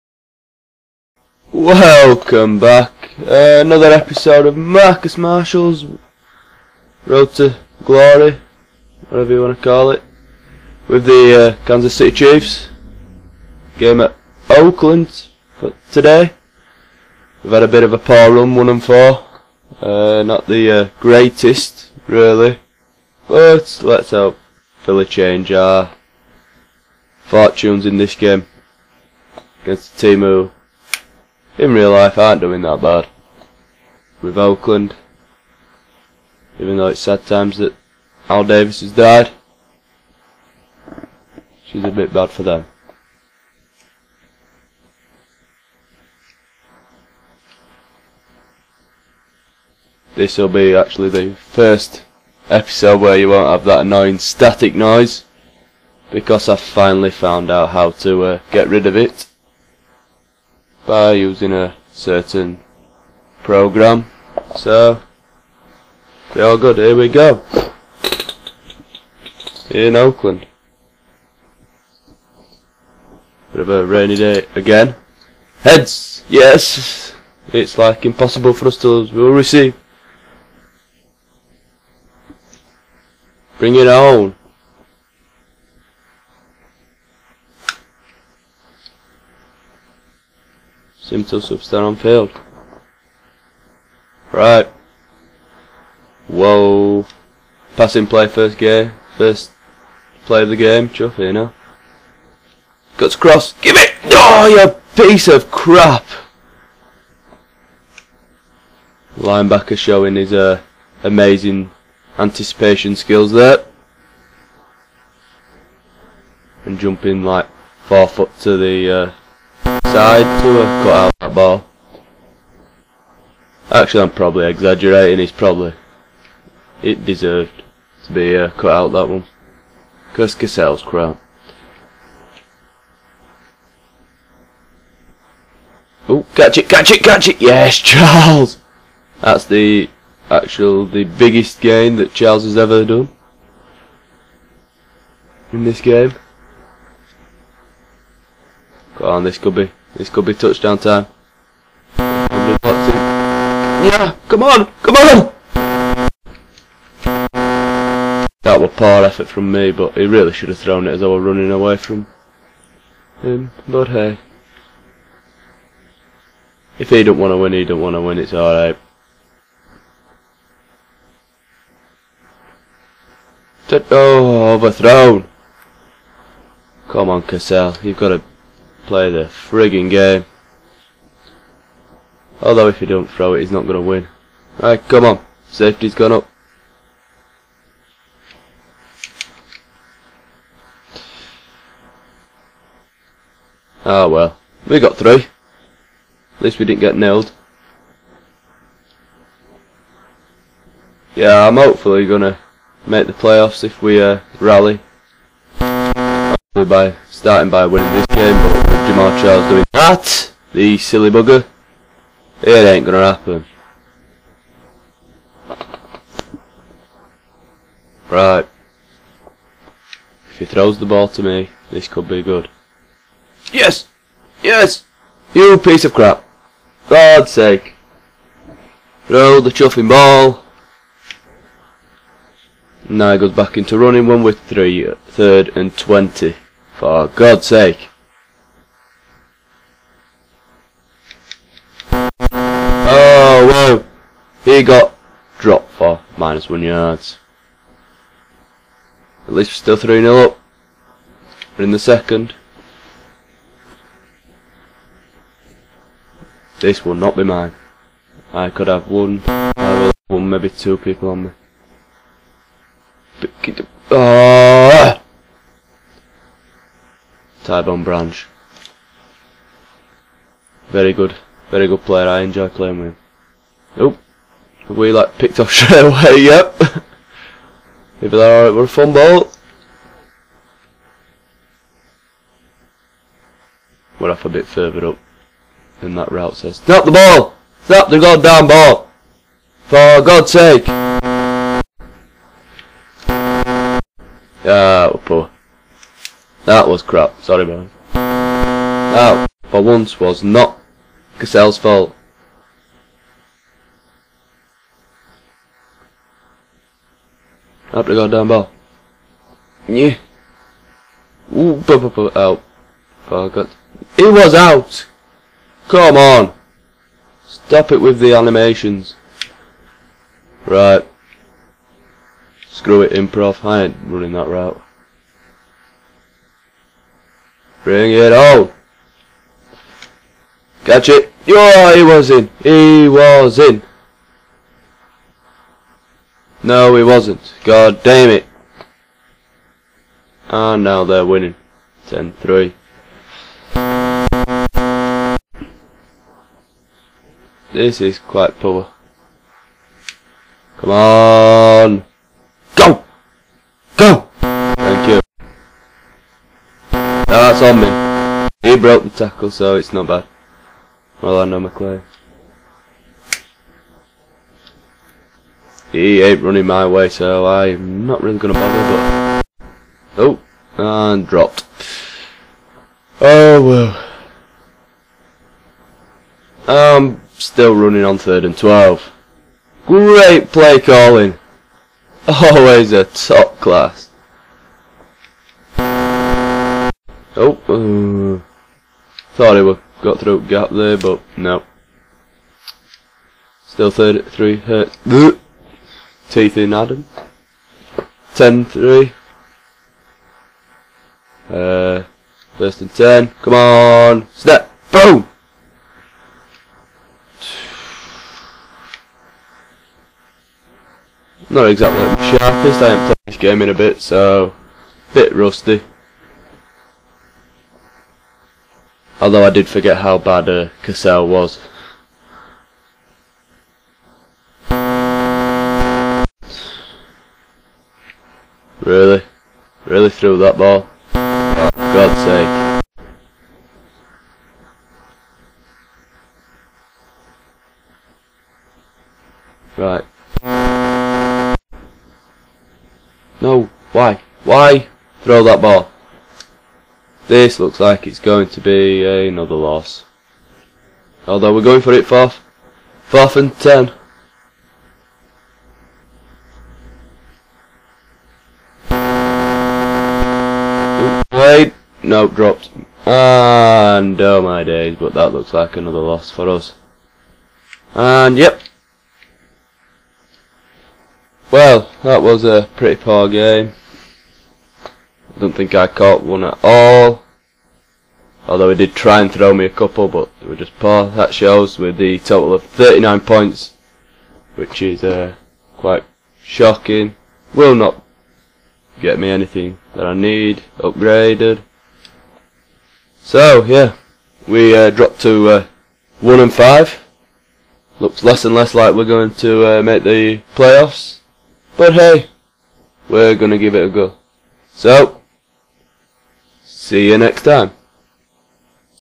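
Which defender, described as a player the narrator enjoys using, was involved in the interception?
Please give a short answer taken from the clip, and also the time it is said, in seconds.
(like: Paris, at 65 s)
Tyvon Branch, at 267 s.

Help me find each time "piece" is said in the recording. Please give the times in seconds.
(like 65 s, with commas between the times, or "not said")
105 s, 225 s.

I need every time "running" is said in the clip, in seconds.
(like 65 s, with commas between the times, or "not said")
161 s, 233 s, 323 s, 366 s, 377 s.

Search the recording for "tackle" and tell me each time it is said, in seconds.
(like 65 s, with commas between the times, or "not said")
358 s.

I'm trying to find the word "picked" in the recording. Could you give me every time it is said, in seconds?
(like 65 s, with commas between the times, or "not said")
275 s.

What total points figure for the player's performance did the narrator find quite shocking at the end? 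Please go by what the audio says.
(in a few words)
39.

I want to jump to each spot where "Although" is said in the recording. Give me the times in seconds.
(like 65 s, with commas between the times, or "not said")
182 s, 419 s, 451 s, 478 s.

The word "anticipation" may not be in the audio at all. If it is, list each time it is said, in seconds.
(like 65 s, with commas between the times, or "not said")
112 s.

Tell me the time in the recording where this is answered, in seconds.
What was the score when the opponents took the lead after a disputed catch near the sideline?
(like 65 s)
341 s.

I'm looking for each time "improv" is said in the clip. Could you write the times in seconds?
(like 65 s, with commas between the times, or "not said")
322 s.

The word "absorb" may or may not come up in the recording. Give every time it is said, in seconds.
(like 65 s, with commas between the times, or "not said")
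not said.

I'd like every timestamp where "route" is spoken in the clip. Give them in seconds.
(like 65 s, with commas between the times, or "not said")
286 s, 324 s.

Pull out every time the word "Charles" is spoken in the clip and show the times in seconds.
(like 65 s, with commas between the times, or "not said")
137 s, 142 s, 209 s.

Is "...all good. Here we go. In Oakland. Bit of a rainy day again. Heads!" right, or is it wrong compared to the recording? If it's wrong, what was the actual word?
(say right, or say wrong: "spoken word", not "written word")
right.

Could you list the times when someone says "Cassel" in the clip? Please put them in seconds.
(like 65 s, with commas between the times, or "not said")
130 s, 177 s, 301 s, 420 s.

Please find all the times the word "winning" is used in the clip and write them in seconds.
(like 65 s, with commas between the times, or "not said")
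207 s, 341 s.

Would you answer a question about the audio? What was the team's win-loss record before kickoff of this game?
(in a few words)
1 and 4.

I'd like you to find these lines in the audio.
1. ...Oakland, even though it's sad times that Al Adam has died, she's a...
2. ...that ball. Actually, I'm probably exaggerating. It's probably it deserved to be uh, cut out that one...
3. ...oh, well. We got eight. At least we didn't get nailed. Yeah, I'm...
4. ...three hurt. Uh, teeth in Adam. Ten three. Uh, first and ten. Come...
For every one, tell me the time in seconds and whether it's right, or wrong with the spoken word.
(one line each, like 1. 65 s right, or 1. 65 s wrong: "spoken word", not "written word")
1. 34 s wrong: "Davis", not "Adam"
2. 121 s right
3. 194 s wrong: "three", not "eight"
4. 394 s right.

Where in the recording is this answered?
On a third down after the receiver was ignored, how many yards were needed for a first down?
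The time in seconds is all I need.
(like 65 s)
235 s.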